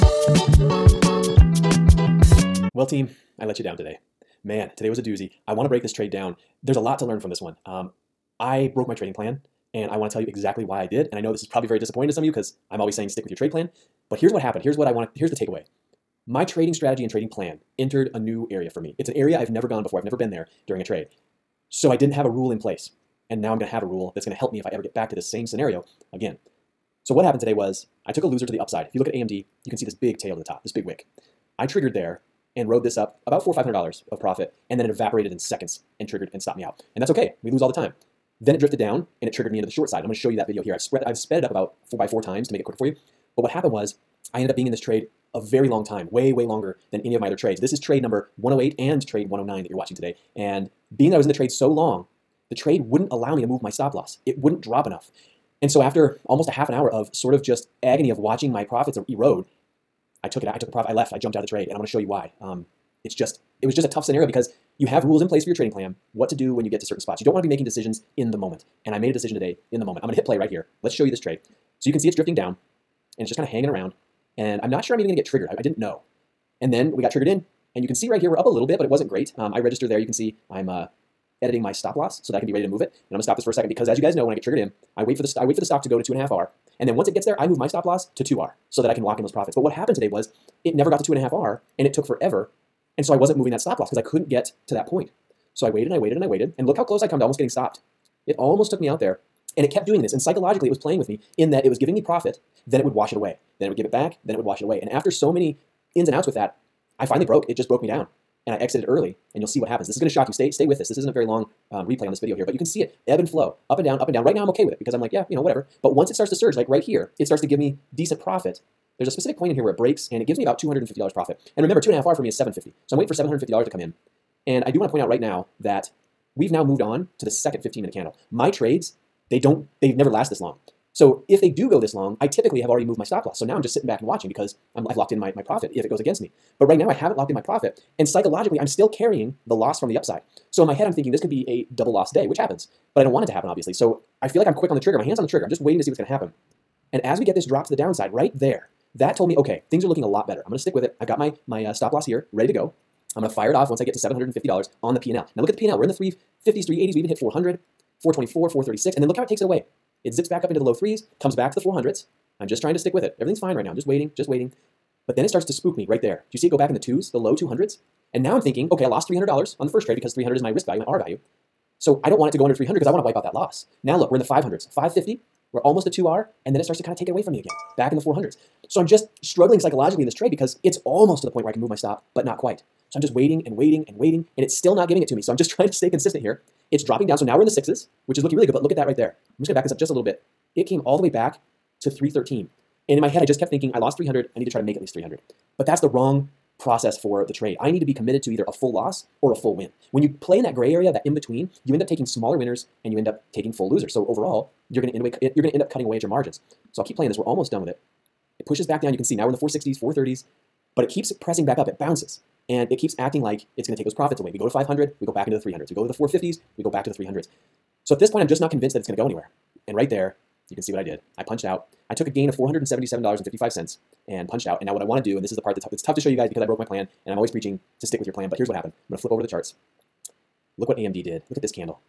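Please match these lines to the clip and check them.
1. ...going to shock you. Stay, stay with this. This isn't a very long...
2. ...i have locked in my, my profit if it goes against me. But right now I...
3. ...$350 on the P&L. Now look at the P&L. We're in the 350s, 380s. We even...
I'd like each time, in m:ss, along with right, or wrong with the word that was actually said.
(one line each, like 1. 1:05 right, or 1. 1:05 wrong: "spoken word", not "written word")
1. 1:49 right
2. 2:14 right
3. 2:33 wrong: "750", not "350".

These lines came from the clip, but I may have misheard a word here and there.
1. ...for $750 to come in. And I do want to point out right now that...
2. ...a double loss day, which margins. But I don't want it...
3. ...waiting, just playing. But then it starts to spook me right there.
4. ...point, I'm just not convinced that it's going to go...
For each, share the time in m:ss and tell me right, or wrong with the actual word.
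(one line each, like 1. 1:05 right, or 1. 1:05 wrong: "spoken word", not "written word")
1. 2:03 right
2. 2:21 wrong: "happens", not "margins"
3. 2:43 wrong: "waiting", not "playing"
4. 3:38 right.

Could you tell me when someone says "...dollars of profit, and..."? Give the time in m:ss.
0:33.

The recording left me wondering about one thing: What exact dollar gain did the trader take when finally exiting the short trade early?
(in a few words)
$477.55.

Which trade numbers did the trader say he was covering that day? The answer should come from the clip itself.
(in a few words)
108 and 109.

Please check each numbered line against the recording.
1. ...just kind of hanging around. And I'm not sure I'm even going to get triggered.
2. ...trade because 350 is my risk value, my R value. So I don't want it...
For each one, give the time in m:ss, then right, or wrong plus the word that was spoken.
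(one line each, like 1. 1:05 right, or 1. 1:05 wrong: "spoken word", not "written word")
1. 1:13 right
2. 2:49 wrong: "300", not "350".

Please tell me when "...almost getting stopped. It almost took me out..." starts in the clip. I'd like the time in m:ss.
1:37.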